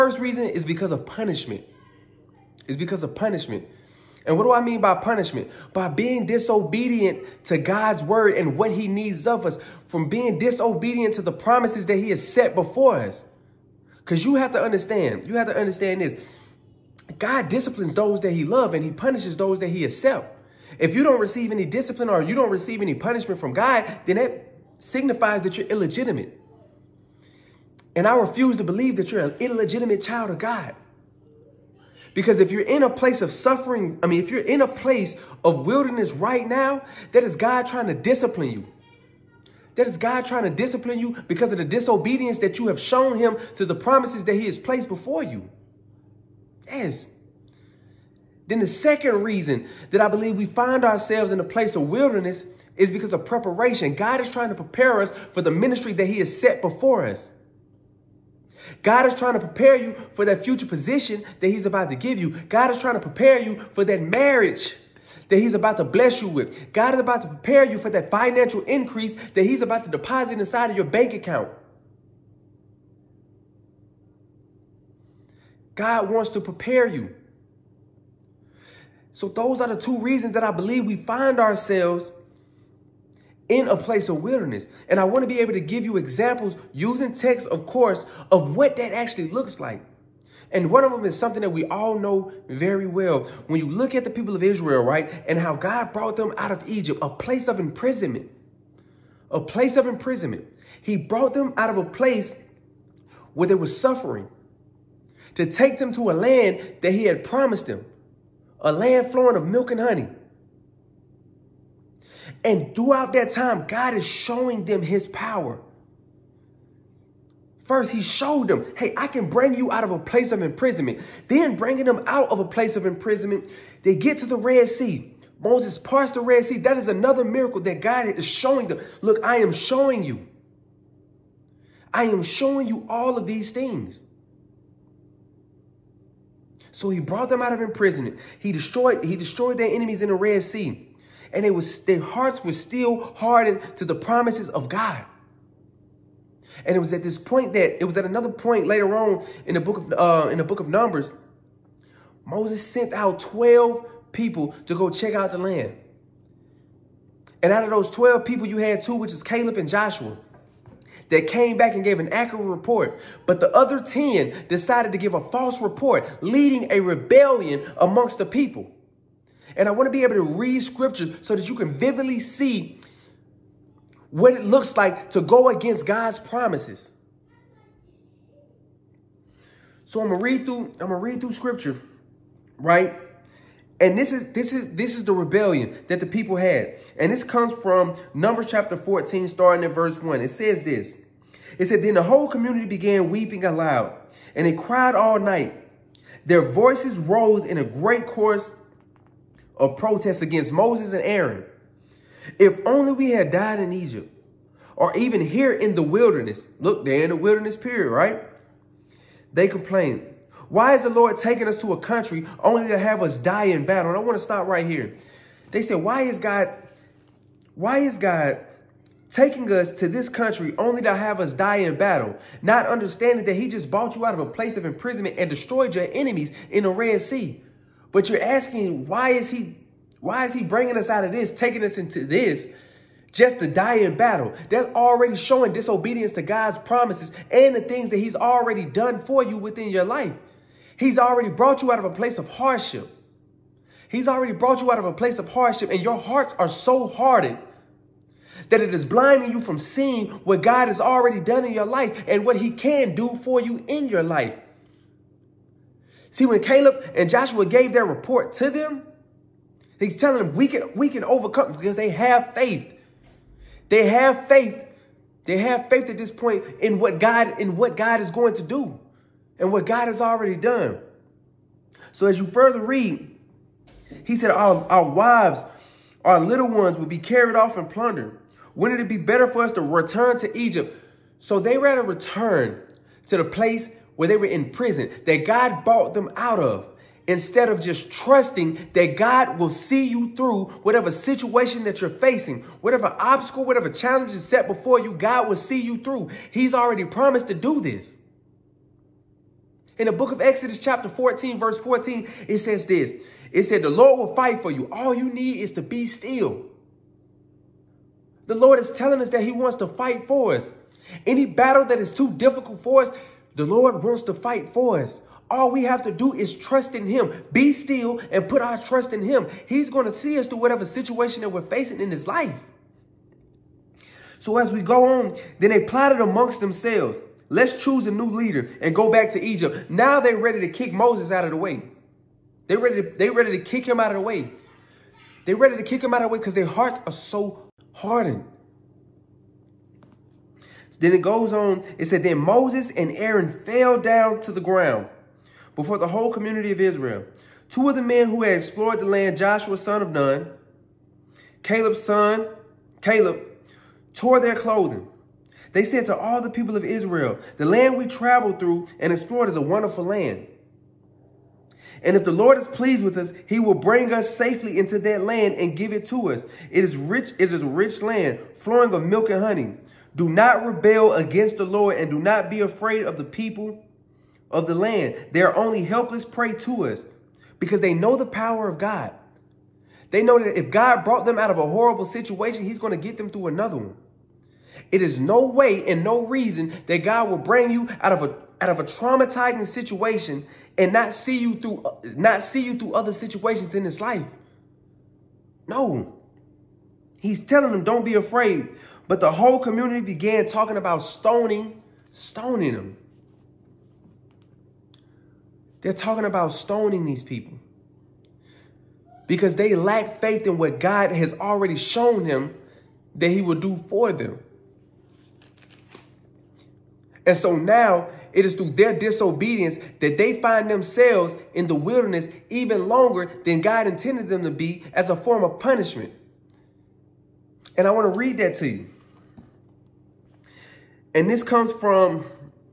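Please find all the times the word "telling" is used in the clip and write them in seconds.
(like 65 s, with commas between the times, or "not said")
259 s, 308 s, 397 s.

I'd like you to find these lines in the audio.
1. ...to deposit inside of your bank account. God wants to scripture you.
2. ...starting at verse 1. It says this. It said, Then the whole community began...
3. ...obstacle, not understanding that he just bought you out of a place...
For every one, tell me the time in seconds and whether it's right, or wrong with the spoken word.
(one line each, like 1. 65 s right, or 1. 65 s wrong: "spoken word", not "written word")
1. 69 s wrong: "prepare", not "scripture"
2. 189 s right
3. 221 s wrong: "battle", not "obstacle".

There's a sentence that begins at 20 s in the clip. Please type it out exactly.
If you don't receive any discipline or you don't receive any punishment from God, then that signifies that you're illegitimate.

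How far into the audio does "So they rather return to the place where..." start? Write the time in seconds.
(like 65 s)
281 s.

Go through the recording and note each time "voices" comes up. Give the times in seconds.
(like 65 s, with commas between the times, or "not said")
196 s.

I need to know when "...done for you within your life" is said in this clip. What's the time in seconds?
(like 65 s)
238 s.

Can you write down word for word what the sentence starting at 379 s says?
They know that if God brought them out of a horrible situation, he's going to get them through another one.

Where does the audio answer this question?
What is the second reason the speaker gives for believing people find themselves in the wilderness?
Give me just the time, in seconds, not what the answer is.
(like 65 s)
52 s.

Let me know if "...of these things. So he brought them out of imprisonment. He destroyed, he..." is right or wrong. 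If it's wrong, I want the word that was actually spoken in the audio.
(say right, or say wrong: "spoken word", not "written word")
right.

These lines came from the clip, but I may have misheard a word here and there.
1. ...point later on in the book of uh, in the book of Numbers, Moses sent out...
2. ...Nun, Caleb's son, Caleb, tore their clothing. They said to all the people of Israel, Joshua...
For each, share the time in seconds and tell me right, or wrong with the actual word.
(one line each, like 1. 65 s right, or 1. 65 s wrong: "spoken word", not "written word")
1. 148 s right
2. 349 s wrong: "The", not "Joshua".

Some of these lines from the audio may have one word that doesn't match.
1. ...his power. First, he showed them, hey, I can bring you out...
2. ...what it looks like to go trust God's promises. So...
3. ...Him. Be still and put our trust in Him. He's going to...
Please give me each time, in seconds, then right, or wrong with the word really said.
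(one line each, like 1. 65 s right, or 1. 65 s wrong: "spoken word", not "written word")
1. 114 s right
2. 174 s wrong: "against", not "trust"
3. 316 s right.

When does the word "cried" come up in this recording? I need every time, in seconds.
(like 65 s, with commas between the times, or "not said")
194 s.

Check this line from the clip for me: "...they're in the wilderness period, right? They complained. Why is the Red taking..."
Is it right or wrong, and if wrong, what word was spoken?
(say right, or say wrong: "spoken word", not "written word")
wrong: "Lord", not "Red".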